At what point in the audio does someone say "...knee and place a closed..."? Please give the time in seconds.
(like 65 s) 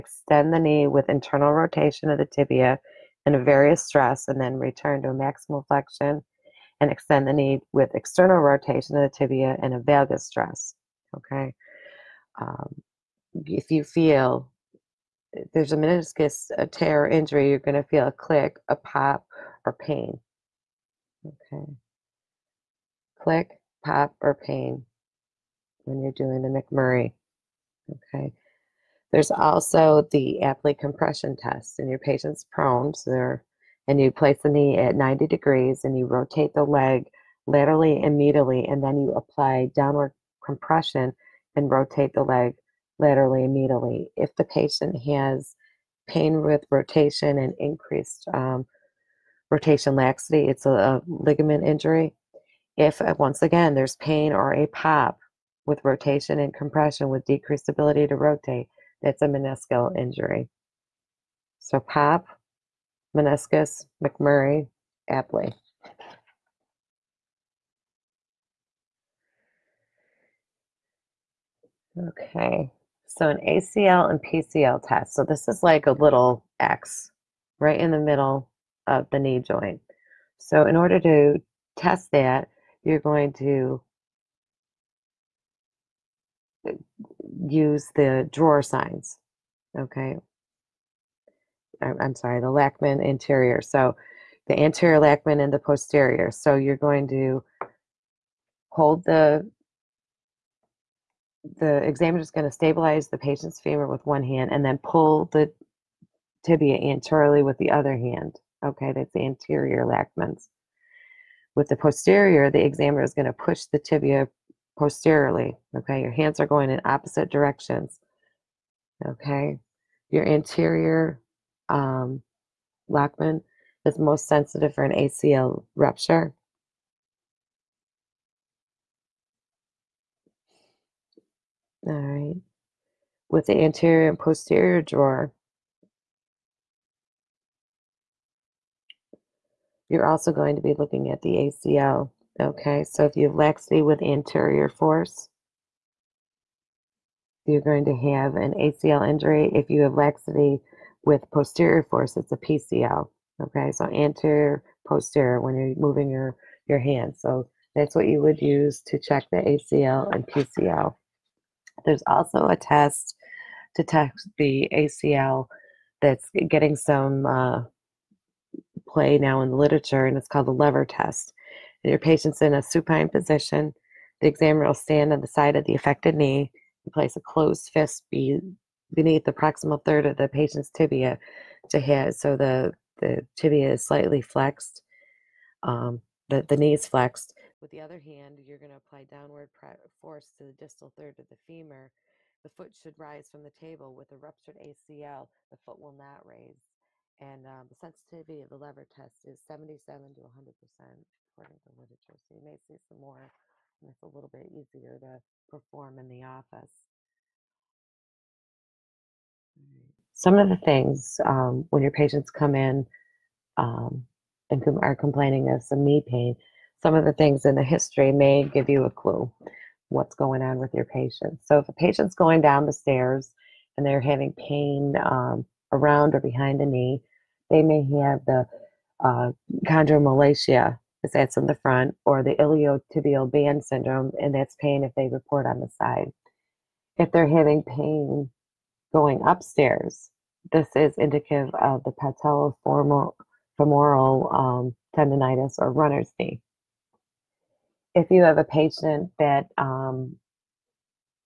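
176 s.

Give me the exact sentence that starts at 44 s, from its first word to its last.
If the patient has pain with rotation and increased um, rotation laxity, it's a, a ligament injury.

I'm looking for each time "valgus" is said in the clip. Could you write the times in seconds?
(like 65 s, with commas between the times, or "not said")
9 s.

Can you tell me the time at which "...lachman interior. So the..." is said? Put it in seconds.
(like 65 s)
92 s.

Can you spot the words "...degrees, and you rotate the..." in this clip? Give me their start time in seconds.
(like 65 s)
35 s.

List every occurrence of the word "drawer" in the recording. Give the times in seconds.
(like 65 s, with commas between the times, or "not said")
88 s, 134 s.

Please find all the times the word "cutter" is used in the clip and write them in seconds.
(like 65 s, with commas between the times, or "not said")
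not said.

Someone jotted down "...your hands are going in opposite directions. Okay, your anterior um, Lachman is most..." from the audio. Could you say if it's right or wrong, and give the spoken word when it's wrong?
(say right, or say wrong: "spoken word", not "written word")
right.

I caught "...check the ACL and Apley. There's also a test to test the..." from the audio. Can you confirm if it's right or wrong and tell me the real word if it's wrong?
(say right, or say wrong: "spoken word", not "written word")
wrong: "PCL", not "Apley".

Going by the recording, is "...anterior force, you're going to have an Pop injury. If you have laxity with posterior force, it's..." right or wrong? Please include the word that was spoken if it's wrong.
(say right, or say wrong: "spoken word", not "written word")
wrong: "ACL", not "Pop".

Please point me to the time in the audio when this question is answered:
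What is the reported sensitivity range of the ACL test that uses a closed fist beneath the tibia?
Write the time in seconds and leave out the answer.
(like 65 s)
199 s.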